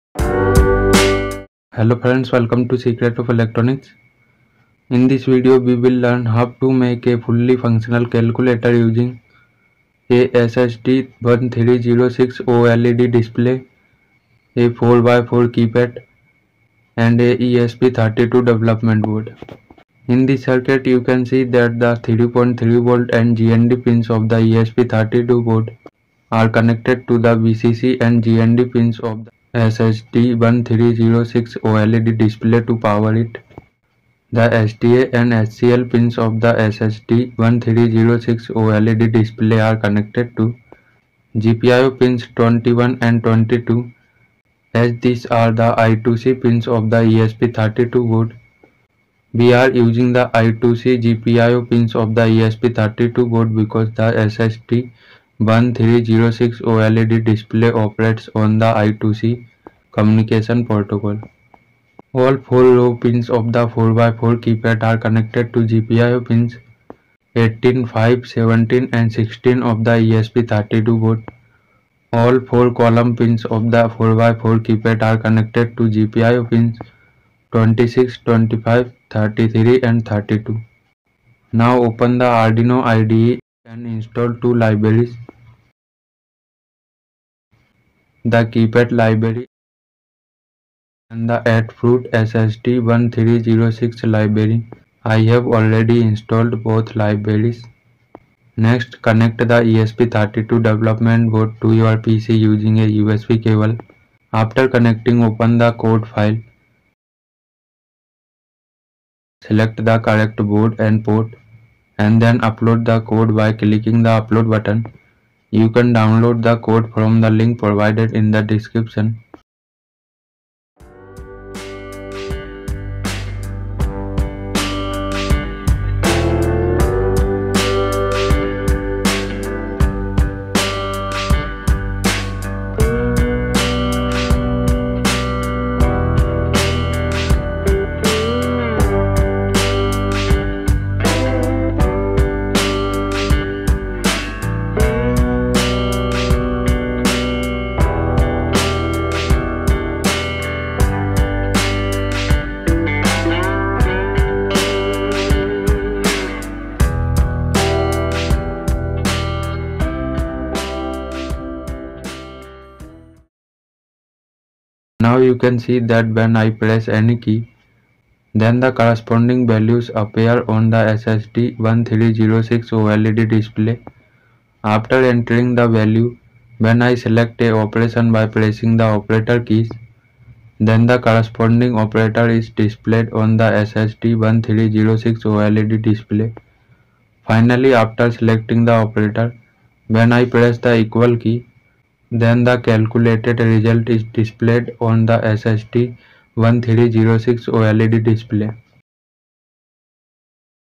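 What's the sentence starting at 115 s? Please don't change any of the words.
You can download the code from the link provided in the description.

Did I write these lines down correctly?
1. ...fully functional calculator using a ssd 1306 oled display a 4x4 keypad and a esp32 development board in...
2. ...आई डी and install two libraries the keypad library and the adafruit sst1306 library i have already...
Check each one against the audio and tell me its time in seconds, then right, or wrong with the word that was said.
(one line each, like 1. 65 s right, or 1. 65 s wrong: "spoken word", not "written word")
1. 7 s right
2. 82 s right.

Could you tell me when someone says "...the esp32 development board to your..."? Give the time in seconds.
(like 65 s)
99 s.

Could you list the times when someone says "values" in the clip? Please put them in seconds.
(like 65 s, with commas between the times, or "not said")
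169 s, 175 s.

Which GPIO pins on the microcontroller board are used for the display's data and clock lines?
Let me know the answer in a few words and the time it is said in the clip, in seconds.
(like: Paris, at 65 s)
21 and 22, at 41 s.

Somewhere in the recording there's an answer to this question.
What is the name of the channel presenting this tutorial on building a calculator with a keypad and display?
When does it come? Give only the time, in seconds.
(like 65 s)
2 s.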